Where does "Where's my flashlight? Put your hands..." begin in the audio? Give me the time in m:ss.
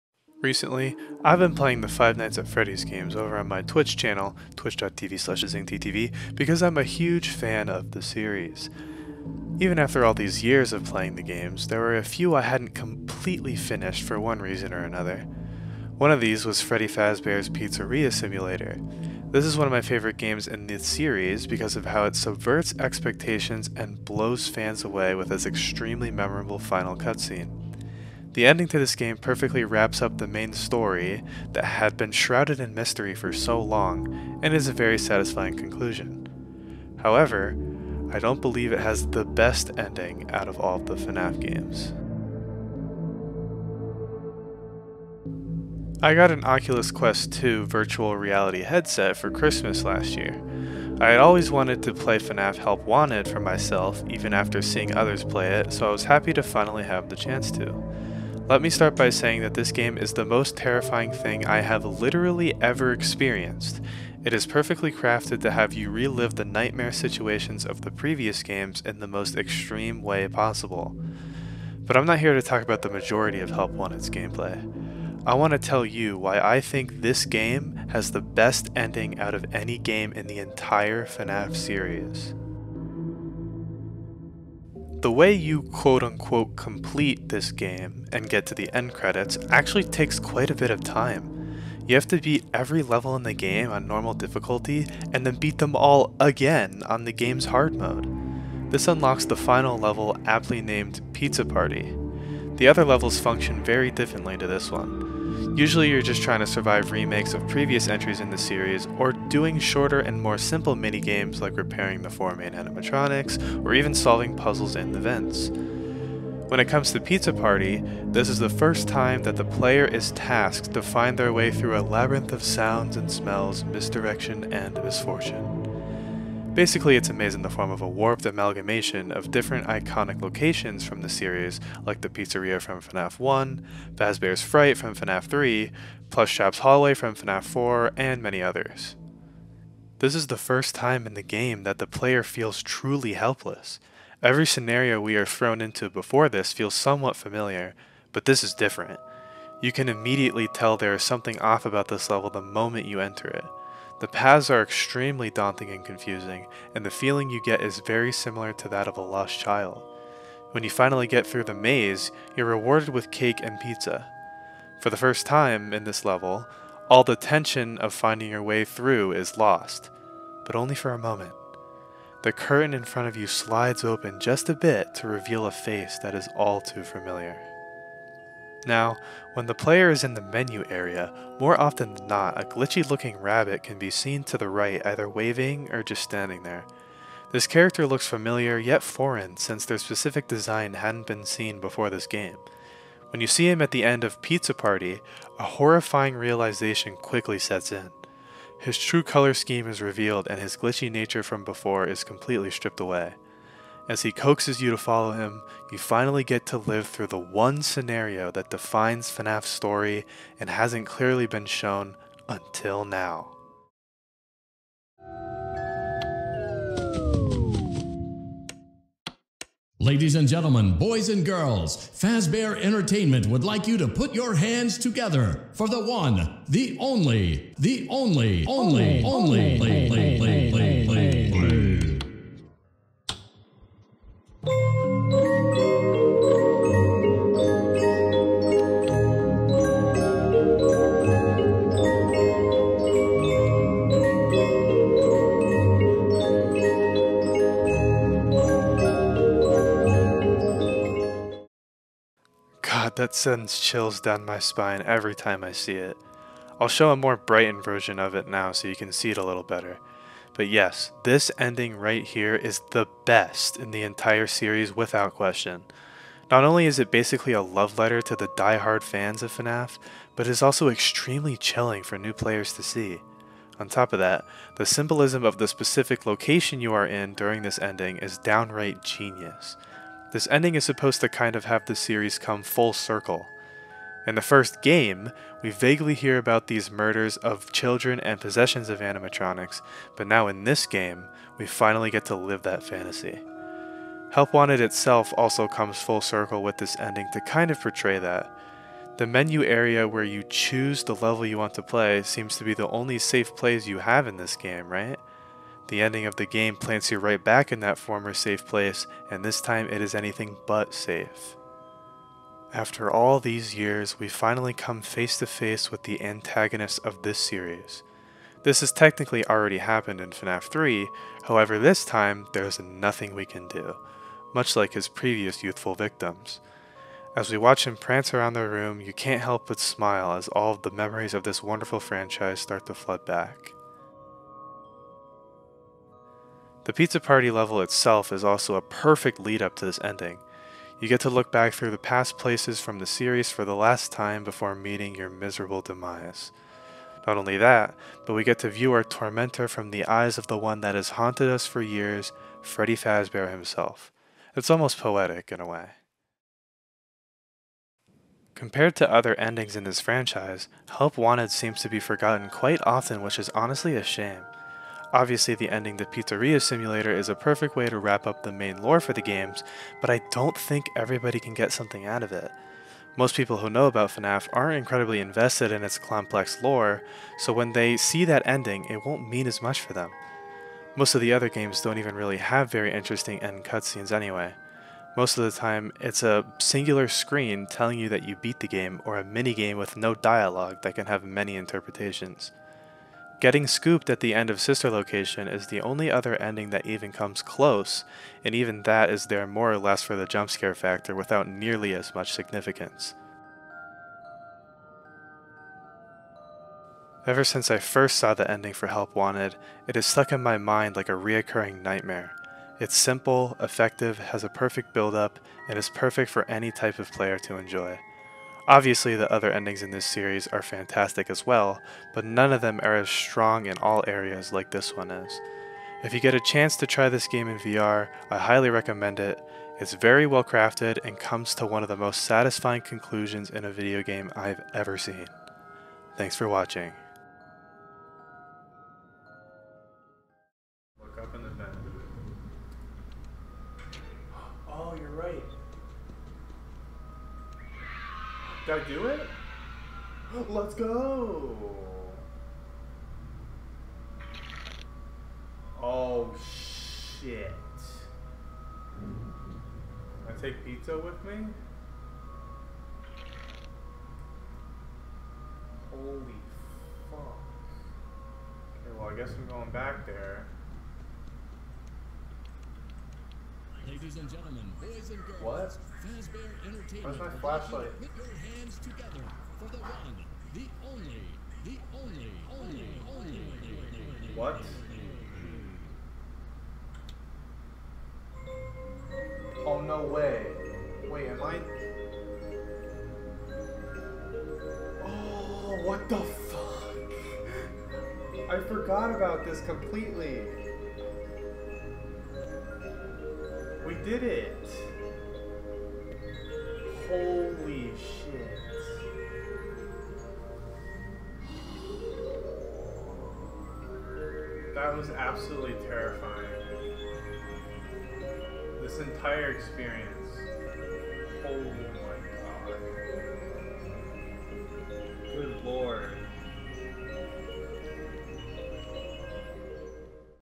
7:56.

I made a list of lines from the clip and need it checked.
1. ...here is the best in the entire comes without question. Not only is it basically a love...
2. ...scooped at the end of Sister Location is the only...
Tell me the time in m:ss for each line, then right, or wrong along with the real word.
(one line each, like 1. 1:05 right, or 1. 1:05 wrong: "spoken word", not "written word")
1. 4:22 wrong: "series", not "comes"
2. 6:33 right.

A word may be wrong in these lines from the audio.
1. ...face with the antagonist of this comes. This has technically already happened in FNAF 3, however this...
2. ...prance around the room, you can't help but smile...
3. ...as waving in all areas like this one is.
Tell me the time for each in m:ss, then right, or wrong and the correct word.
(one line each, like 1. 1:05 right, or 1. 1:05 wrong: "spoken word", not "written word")
1. 5:15 wrong: "series", not "comes"
2. 5:27 right
3. 7:02 wrong: "strong", not "waving".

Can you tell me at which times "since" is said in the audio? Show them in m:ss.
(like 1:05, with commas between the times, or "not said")
3:09, 6:47.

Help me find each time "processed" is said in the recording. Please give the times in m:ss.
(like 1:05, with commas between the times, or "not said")
not said.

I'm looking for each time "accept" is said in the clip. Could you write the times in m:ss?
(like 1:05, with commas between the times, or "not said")
not said.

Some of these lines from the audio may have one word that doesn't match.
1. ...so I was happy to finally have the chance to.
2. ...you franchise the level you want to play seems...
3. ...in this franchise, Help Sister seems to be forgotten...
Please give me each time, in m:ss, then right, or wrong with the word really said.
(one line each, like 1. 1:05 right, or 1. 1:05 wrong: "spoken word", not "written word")
1. 0:55 right
2. 5:00 wrong: "choose", not "franchise"
3. 5:59 wrong: "Wanted", not "Sister".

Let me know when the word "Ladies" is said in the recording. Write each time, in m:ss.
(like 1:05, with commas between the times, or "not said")
3:39, 7:53.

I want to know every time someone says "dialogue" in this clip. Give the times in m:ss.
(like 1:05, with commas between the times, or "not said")
6:29.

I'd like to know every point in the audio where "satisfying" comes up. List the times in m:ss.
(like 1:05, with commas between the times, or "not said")
0:34, 7:12.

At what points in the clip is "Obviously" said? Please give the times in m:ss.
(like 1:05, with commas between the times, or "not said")
6:04, 6:58.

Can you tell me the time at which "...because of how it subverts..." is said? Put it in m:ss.
0:21.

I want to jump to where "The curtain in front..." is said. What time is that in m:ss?
2:52.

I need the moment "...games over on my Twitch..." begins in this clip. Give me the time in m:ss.
0:02.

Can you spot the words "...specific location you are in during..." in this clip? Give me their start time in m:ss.
4:35.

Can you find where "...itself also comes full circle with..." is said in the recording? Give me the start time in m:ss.
4:54.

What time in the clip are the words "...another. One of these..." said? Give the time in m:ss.
0:14.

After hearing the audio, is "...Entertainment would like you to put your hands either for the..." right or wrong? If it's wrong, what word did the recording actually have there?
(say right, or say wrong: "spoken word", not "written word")
wrong: "together", not "either".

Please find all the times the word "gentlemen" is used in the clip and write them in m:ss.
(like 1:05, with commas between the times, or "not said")
3:40, 7:54.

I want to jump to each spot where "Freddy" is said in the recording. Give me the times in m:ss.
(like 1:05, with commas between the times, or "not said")
0:02, 0:16, 5:52.